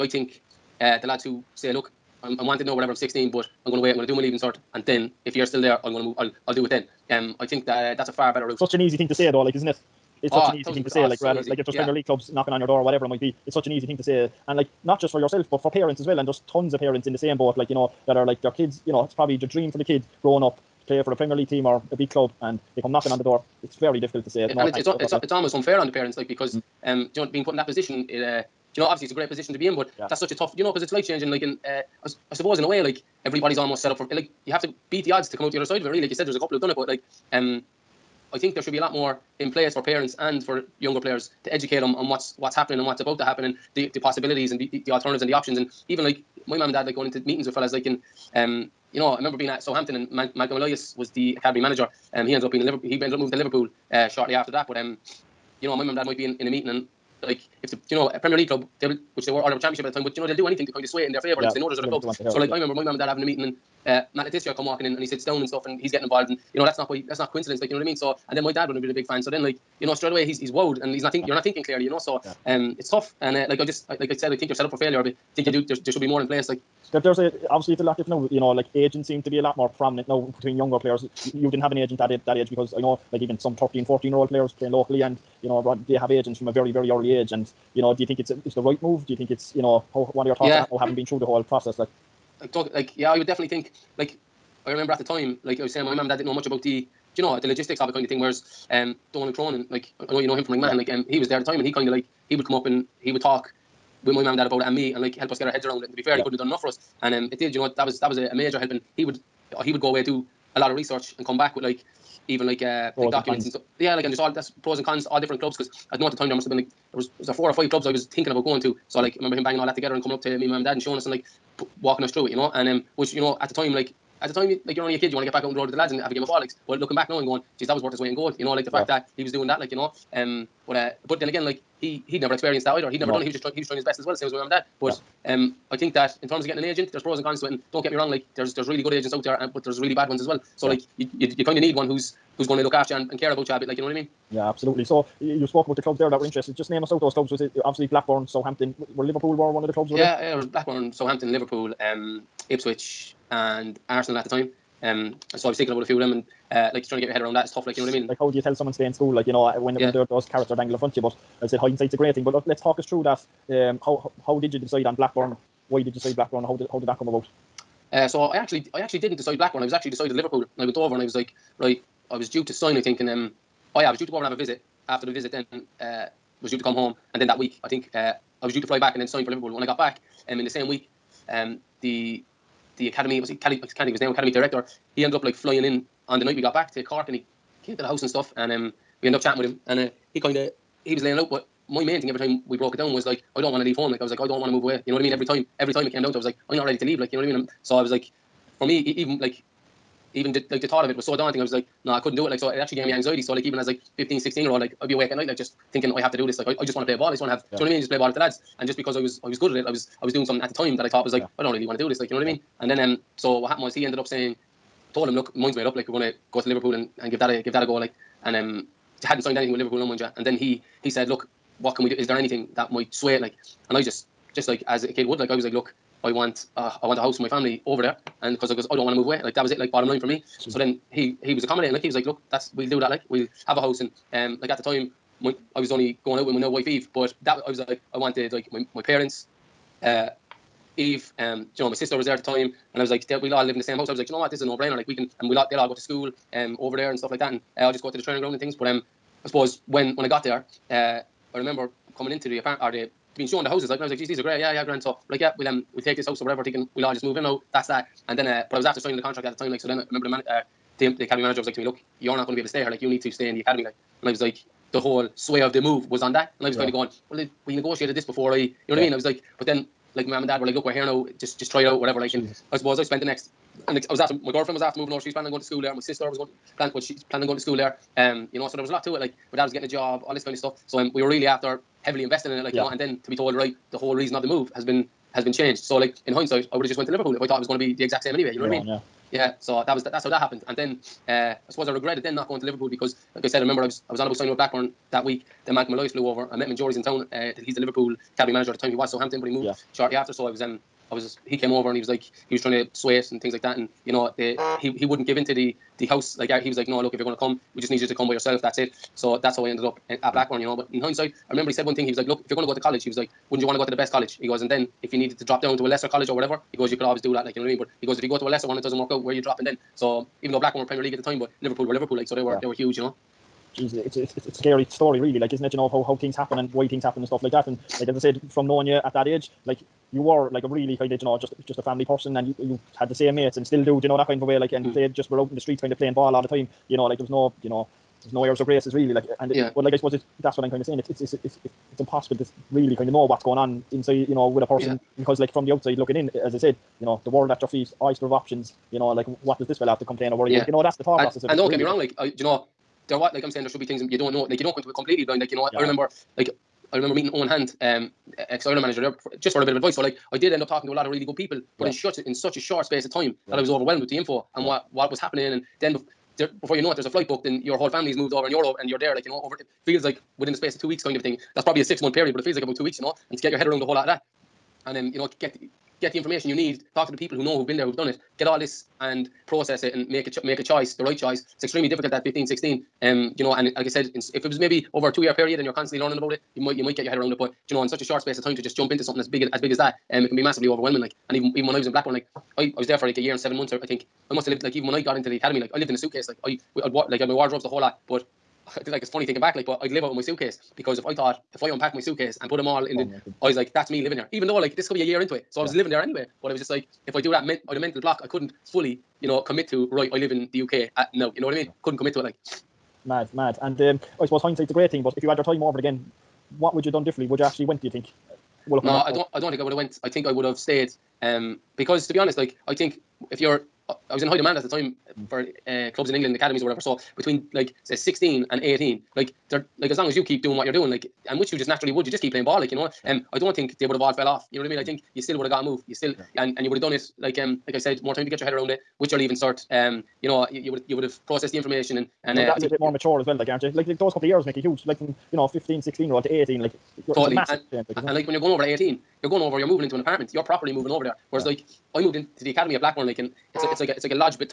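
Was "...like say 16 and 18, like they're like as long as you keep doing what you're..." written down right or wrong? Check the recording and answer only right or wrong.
right.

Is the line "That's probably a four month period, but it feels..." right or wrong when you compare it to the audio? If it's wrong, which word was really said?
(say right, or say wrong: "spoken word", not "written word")
wrong: "six", not "four".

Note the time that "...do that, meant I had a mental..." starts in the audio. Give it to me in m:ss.
6:46.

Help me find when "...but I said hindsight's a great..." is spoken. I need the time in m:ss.
2:40.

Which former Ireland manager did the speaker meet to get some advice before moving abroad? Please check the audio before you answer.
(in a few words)
Eoin Hand.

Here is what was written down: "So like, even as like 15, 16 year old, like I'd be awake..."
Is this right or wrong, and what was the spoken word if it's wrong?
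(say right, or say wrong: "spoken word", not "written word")
right.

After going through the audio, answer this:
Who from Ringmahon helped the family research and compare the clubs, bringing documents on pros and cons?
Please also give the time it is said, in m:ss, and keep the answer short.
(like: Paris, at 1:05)
Donald Cronin, at 1:39.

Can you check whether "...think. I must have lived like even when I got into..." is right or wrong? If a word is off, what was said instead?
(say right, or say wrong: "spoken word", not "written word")
right.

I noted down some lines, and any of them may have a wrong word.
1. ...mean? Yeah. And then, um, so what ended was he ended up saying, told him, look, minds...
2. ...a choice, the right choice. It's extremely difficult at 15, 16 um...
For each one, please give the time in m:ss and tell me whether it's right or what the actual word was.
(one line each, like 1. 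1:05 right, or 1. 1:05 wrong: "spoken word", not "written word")
1. 3:32 wrong: "happened", not "ended"
2. 6:20 right.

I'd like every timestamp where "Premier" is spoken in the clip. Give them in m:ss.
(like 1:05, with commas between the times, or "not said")
0:11, 0:21, 0:58, 5:20.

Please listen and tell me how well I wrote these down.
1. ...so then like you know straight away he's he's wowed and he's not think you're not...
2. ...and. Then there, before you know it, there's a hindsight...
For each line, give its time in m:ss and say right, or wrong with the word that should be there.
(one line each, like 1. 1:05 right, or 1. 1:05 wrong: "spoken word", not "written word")
1. 1:09 right
2. 6:05 wrong: "flight", not "hindsight".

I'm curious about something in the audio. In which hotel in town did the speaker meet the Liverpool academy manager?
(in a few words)
Jury's.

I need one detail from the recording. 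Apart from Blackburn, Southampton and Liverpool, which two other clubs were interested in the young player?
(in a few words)
Ipswich and Arsenal.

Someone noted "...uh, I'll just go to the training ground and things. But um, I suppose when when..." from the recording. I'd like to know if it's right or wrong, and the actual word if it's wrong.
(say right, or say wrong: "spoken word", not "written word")
right.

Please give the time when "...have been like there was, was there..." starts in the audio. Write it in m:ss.
1:56.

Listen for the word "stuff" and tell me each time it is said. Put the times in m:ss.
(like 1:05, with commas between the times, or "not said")
1:05, 1:53, 3:08, 4:06, 4:40, 5:27.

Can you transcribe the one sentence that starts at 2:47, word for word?
Uh, so I actually I actually didn't decide Blackburn.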